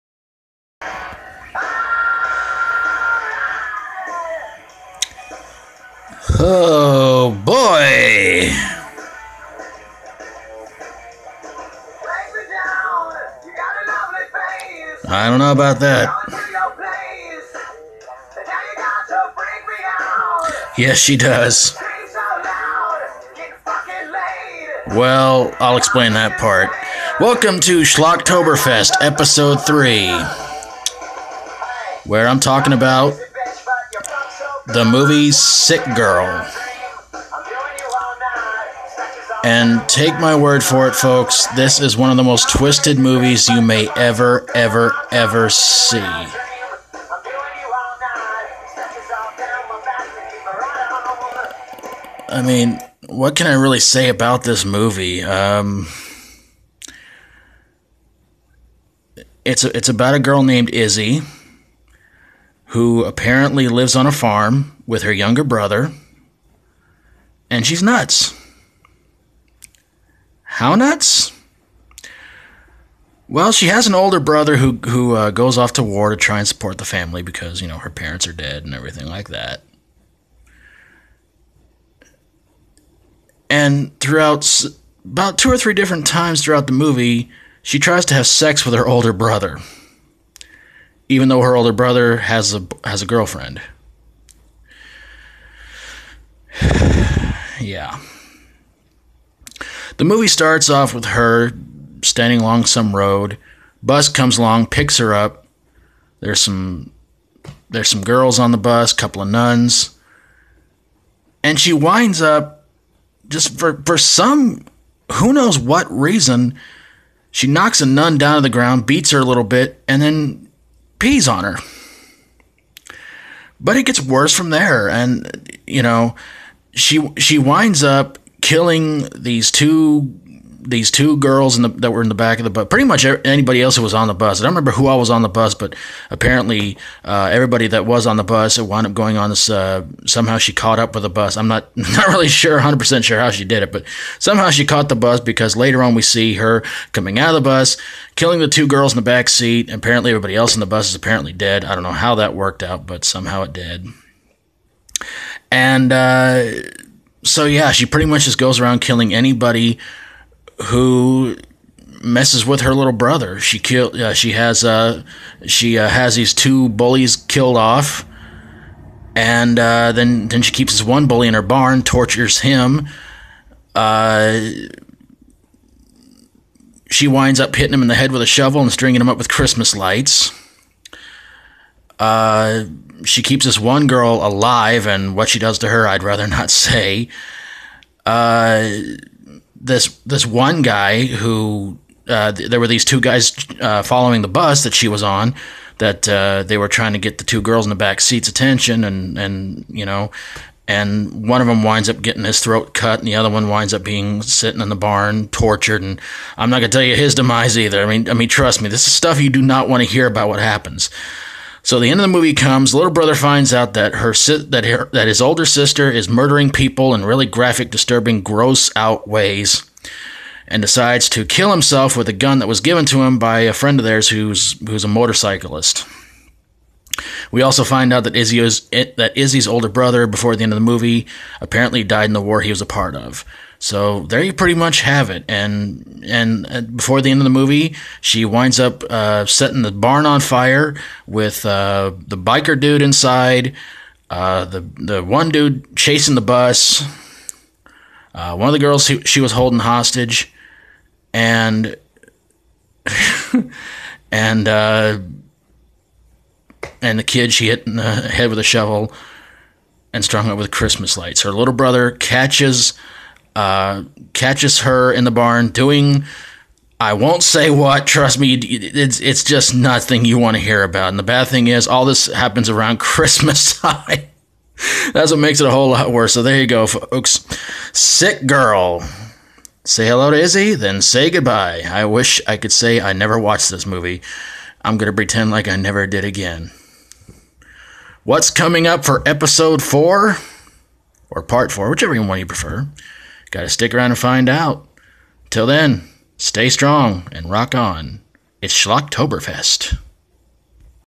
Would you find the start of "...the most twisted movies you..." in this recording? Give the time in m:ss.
0:42.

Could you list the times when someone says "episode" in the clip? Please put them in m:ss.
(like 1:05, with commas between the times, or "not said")
0:29, 4:49.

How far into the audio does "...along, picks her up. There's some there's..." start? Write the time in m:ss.
1:44.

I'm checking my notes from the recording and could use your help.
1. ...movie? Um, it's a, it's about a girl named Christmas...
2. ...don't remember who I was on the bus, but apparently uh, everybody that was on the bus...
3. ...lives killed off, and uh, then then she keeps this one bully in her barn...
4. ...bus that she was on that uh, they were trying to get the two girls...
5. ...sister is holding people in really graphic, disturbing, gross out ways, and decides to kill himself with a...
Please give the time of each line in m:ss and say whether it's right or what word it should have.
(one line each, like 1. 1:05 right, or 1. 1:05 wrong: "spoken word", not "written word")
1. 0:54 wrong: "Izzy", not "Christmas"
2. 2:14 right
3. 2:46 wrong: "bullies", not "lives"
4. 3:14 right
5. 3:35 wrong: "murdering", not "holding".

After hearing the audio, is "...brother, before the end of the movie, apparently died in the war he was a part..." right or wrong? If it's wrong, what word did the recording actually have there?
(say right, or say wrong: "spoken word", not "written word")
right.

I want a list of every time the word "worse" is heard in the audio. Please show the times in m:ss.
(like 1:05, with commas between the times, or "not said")
2:04, 4:35.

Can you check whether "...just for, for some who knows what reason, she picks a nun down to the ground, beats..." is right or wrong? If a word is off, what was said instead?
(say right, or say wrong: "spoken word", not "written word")
wrong: "knocks", not "picks".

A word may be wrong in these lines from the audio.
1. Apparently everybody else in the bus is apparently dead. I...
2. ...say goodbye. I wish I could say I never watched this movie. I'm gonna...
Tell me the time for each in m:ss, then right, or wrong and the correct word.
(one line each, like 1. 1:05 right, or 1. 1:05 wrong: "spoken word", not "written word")
1. 2:29 right
2. 4:40 right.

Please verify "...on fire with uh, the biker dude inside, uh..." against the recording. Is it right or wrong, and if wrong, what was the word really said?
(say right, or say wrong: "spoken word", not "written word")
right.